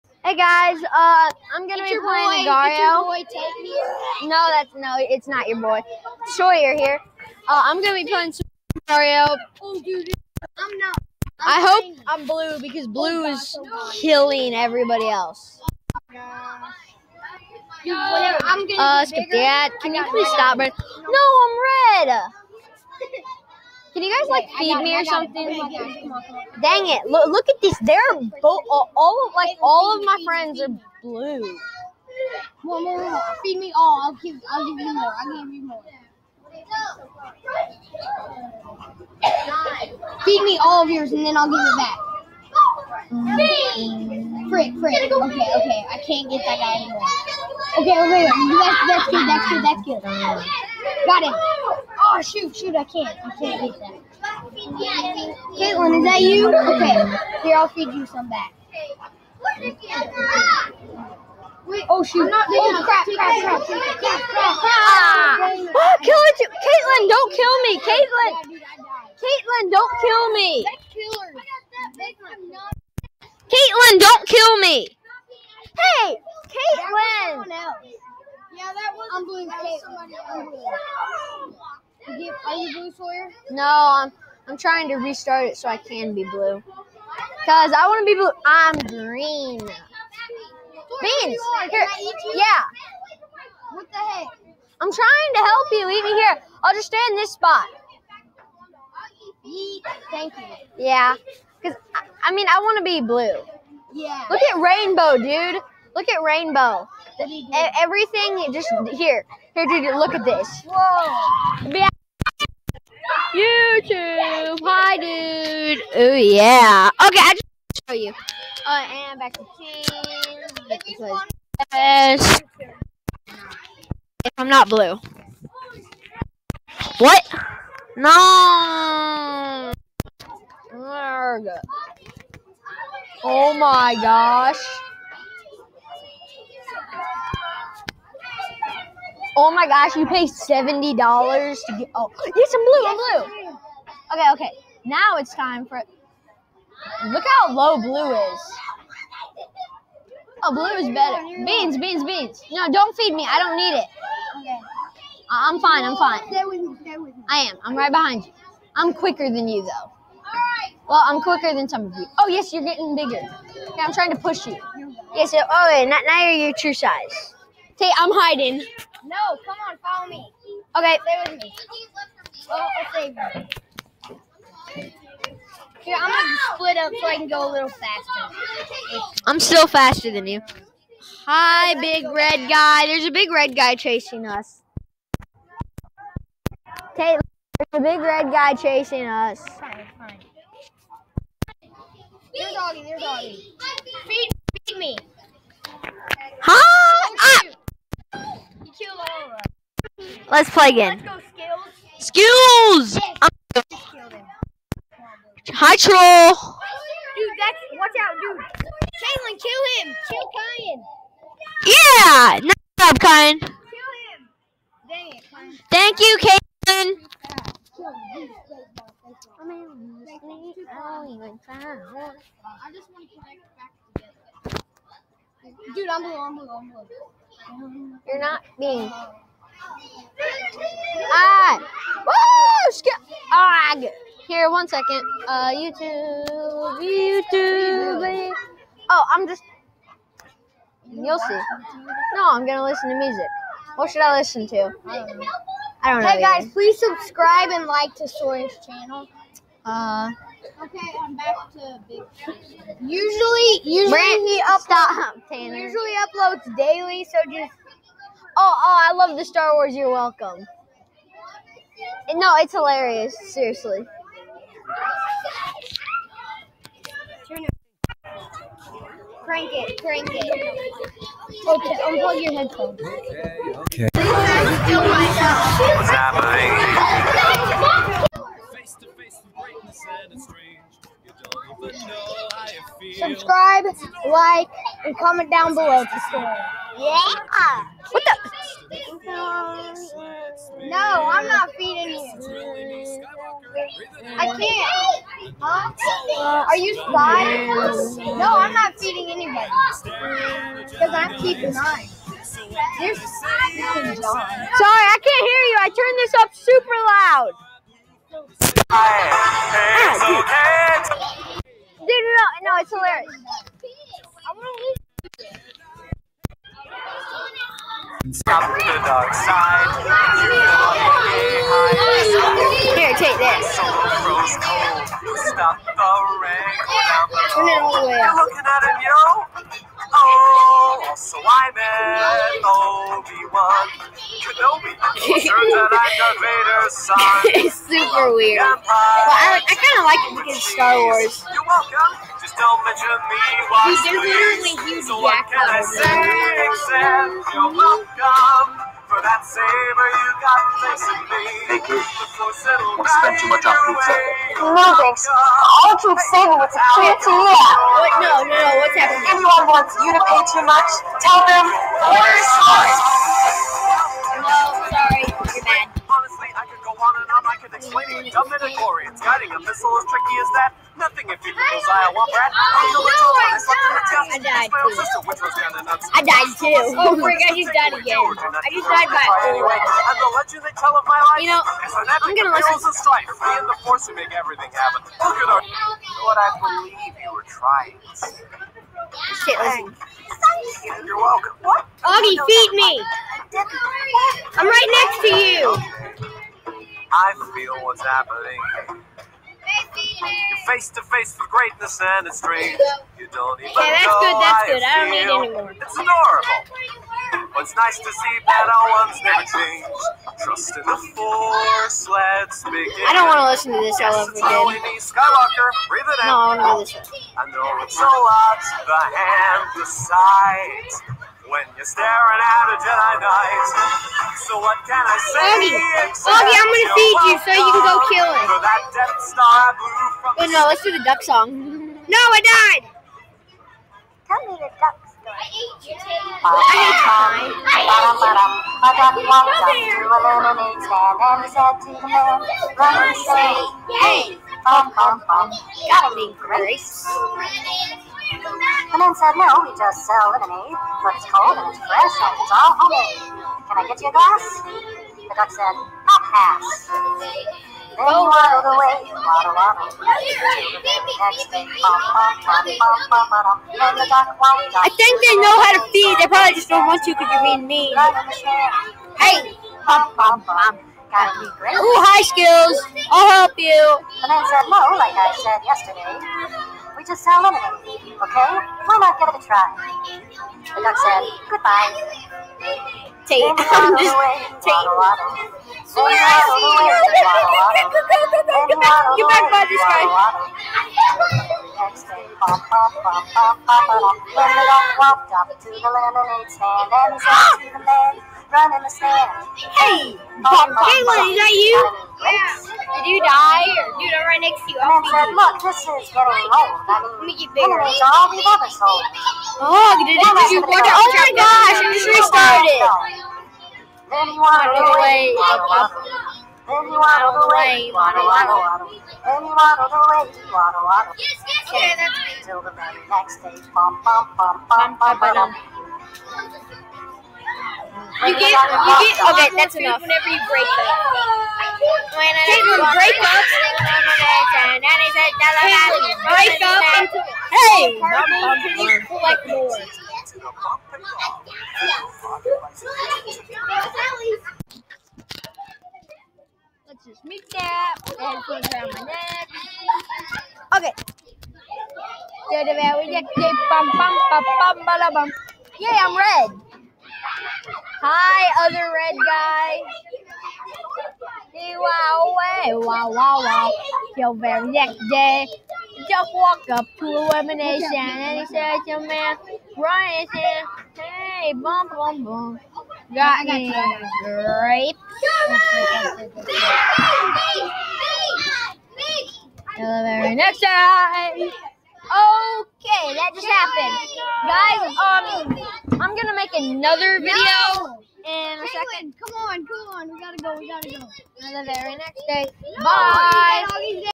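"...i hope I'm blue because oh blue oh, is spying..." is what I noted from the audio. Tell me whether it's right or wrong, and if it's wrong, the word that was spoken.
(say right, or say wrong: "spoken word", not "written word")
wrong: "killing", not "spying".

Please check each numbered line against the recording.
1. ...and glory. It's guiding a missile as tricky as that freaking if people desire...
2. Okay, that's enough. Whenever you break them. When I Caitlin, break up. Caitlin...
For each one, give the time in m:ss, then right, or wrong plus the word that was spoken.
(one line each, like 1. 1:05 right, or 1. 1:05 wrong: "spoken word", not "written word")
1. 6:08 wrong: "nothing", not "freaking"
2. 8:49 right.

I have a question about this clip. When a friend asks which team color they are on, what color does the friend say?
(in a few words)
Green.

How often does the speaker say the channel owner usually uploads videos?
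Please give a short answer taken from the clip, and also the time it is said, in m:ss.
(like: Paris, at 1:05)
Daily, at 4:16.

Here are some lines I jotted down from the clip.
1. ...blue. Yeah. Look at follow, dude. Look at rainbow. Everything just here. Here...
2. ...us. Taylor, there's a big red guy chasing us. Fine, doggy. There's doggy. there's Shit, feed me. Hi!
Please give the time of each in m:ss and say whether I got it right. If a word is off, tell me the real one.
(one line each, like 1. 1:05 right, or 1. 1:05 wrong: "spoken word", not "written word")
1. 1:43 wrong: "rainbow", not "follow"
2. 3:04 wrong: "Feed", not "Shit".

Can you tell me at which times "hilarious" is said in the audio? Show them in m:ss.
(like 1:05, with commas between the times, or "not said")
4:22, 5:12.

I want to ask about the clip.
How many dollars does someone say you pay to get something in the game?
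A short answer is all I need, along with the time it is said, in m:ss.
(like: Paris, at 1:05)
$70, at 2:20.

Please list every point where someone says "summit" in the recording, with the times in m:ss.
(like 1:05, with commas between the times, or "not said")
not said.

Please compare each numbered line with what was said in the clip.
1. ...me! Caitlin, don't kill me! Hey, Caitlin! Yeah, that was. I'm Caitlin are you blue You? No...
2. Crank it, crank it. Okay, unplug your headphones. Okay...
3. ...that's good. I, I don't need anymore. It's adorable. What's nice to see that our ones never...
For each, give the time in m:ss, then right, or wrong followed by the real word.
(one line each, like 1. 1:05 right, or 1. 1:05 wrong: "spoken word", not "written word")
1. 1:10 wrong: "Sawyer", not "You"
2. 4:29 right
3. 6:44 right.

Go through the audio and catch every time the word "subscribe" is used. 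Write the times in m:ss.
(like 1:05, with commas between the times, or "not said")
4:06, 4:42.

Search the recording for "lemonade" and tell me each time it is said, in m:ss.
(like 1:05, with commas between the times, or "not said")
7:30, 7:57, 8:15.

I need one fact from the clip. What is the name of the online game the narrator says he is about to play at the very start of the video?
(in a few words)
Agario.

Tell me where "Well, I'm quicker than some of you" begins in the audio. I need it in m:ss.
2:40.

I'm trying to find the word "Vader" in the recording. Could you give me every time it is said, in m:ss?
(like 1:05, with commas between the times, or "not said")
5:36.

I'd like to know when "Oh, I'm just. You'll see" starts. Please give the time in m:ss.
3:58.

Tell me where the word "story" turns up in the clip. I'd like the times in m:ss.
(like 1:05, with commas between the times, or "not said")
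7:14.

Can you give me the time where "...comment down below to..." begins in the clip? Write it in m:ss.
4:44.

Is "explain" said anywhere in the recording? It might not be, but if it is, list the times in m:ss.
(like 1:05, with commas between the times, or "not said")
6:07.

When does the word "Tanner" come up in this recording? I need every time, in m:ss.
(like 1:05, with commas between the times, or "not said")
4:15.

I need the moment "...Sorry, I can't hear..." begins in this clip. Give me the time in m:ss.
5:03.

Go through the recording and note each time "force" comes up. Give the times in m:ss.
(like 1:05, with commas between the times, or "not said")
6:23, 6:50.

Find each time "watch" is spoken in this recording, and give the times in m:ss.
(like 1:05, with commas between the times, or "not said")
3:27, 8:30.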